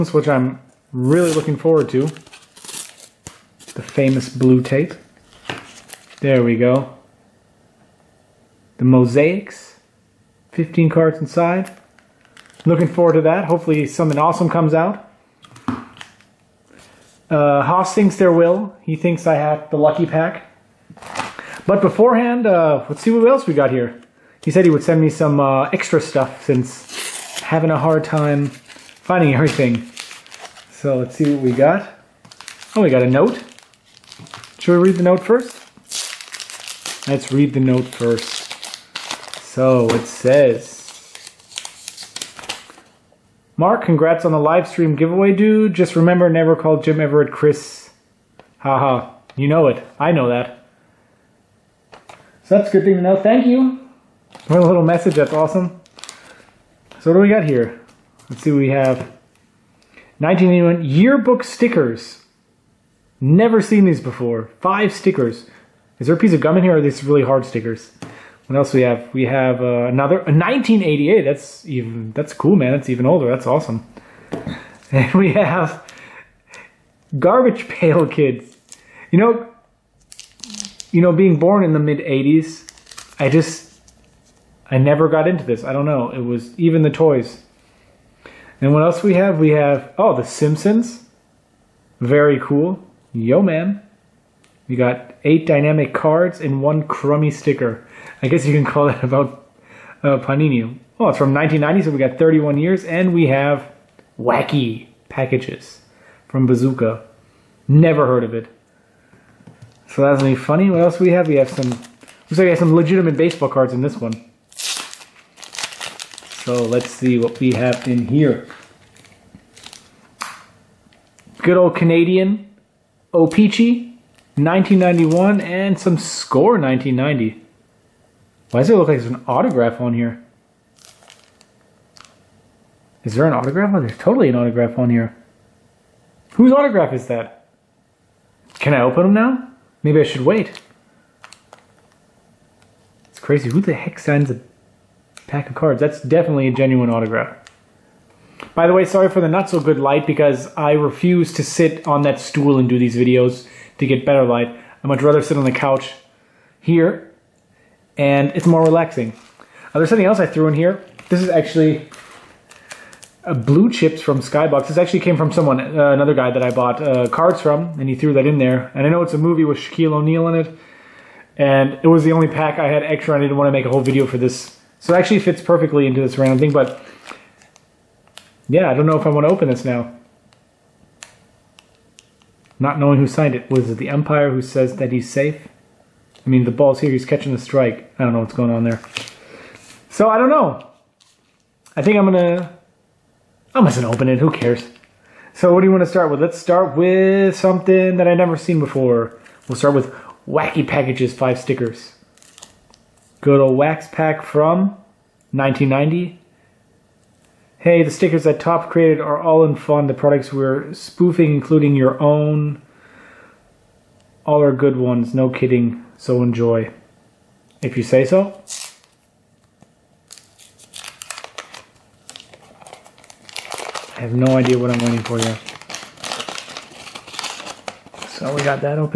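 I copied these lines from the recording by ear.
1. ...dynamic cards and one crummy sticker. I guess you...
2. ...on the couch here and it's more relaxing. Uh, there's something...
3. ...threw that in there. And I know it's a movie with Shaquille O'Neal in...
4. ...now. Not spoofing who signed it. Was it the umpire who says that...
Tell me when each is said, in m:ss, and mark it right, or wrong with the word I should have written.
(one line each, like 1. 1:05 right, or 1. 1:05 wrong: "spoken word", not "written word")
1. 1:35 right
2. 2:35 right
3. 2:47 right
4. 2:59 wrong: "knowing", not "spoofing".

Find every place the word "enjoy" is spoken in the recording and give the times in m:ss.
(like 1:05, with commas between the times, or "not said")
3:36.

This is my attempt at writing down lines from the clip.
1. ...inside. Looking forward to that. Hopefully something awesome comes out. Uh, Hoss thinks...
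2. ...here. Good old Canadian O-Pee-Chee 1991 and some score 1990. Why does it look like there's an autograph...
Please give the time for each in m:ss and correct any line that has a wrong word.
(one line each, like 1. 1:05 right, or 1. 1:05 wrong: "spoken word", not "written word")
1. 0:11 right
2. 1:58 right.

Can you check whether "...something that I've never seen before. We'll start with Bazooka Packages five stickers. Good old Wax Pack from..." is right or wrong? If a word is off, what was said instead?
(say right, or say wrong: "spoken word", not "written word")
wrong: "Wacky", not "Bazooka".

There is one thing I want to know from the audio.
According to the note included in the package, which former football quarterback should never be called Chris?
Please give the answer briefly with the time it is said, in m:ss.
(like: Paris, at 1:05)
Jim Everett, at 0:46.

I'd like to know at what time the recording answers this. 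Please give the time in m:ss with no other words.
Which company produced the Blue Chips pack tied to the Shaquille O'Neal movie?
2:44.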